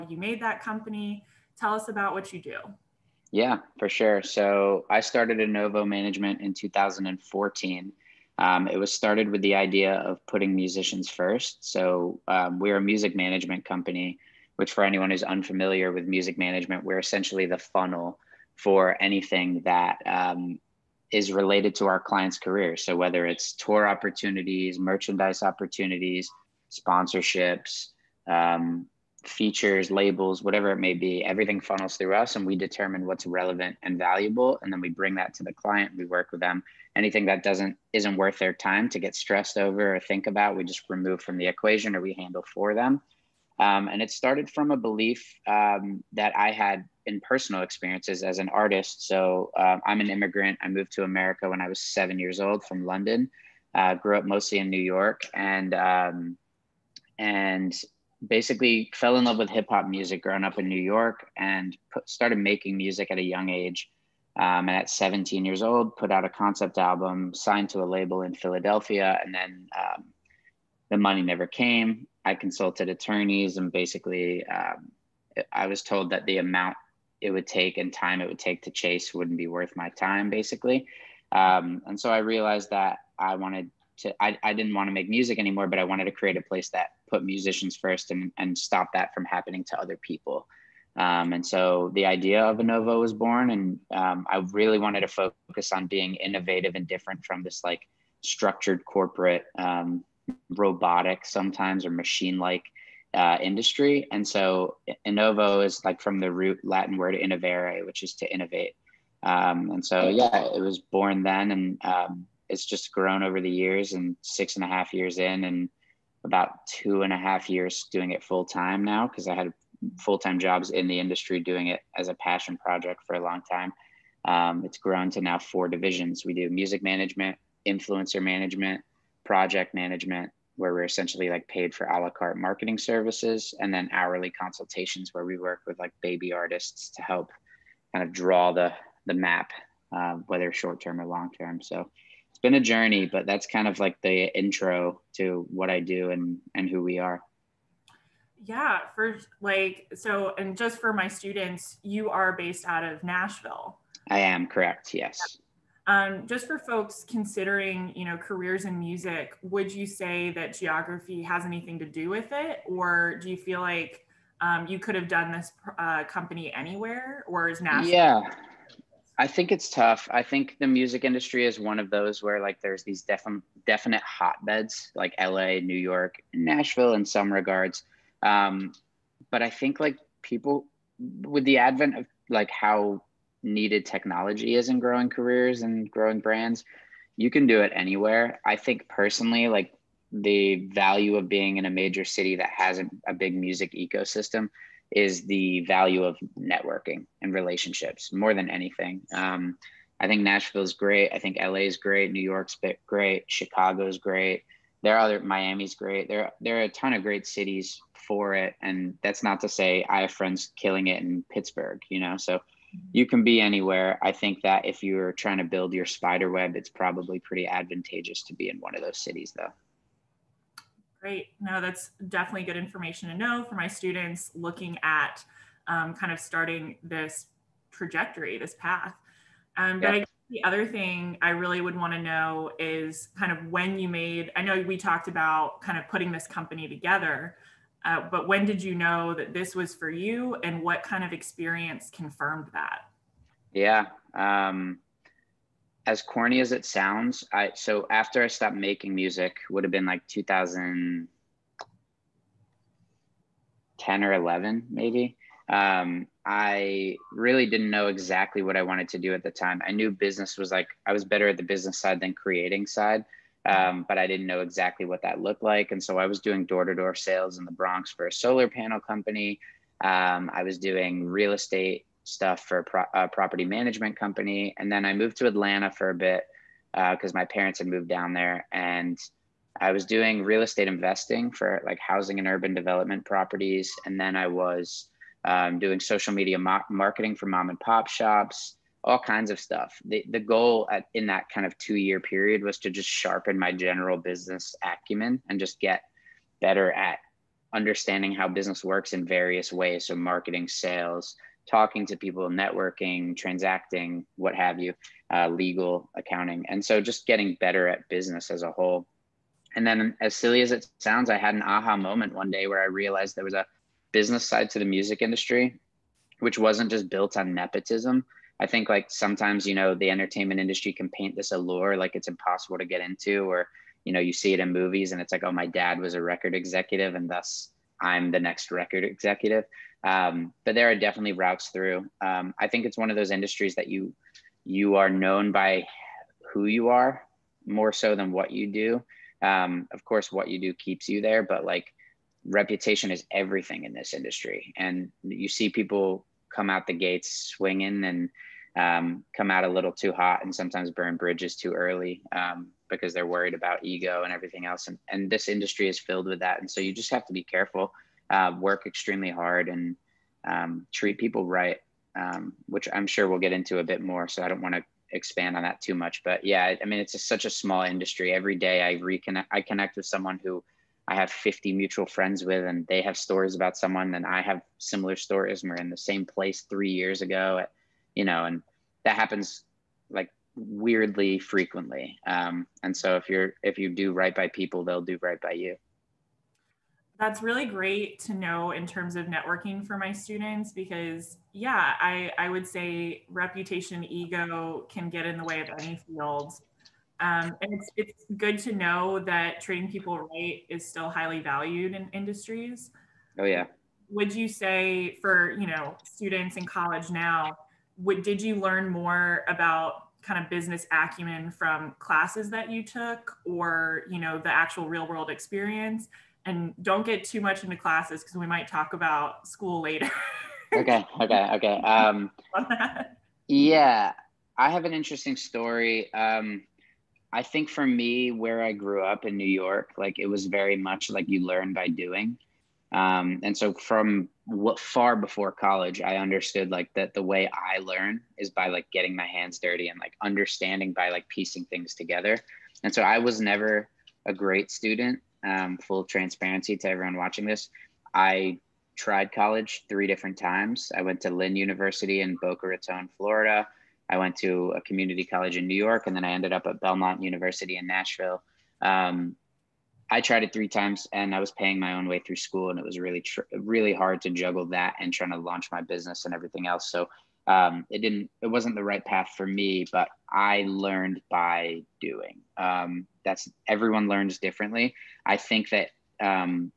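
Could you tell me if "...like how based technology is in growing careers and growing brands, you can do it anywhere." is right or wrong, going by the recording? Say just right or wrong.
wrong.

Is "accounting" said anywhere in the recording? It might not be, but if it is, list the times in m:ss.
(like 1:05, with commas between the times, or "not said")
5:05.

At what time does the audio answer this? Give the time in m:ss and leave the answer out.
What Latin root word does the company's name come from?
1:47.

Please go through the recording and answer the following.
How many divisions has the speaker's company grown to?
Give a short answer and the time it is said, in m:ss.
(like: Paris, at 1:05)
4, at 2:05.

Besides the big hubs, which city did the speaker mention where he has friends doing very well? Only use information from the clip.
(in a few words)
Pittsburgh.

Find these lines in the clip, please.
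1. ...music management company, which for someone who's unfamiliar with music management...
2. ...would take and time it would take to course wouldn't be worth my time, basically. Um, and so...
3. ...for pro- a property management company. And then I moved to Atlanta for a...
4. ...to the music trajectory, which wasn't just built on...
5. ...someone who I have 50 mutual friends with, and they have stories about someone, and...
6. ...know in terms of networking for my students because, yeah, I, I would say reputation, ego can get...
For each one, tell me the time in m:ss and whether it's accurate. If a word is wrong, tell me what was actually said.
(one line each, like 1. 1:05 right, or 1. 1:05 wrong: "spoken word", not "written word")
1. 0:12 wrong: "anyone", not "someone"
2. 1:17 wrong: "chase", not "course"
3. 4:32 right
4. 5:14 wrong: "industry", not "trajectory"
5. 6:09 right
6. 6:28 right.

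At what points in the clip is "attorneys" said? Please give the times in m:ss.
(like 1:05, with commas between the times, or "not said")
1:12.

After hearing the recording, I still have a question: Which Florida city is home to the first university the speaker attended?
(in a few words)
Boca Raton.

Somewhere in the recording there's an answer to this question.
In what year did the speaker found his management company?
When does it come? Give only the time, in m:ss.
0:06.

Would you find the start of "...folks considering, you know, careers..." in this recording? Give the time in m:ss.
2:36.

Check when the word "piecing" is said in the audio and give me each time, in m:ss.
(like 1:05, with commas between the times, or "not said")
7:21.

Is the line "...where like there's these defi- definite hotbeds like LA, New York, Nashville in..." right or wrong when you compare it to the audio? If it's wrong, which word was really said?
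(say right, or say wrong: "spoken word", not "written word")
right.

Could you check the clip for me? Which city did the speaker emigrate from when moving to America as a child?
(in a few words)
London.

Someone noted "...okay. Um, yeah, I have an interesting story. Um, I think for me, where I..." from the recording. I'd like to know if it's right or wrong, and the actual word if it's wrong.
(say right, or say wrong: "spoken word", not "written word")
right.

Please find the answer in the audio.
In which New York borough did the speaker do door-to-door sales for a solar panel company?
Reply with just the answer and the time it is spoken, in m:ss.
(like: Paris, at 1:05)
the Bronx, at 4:27.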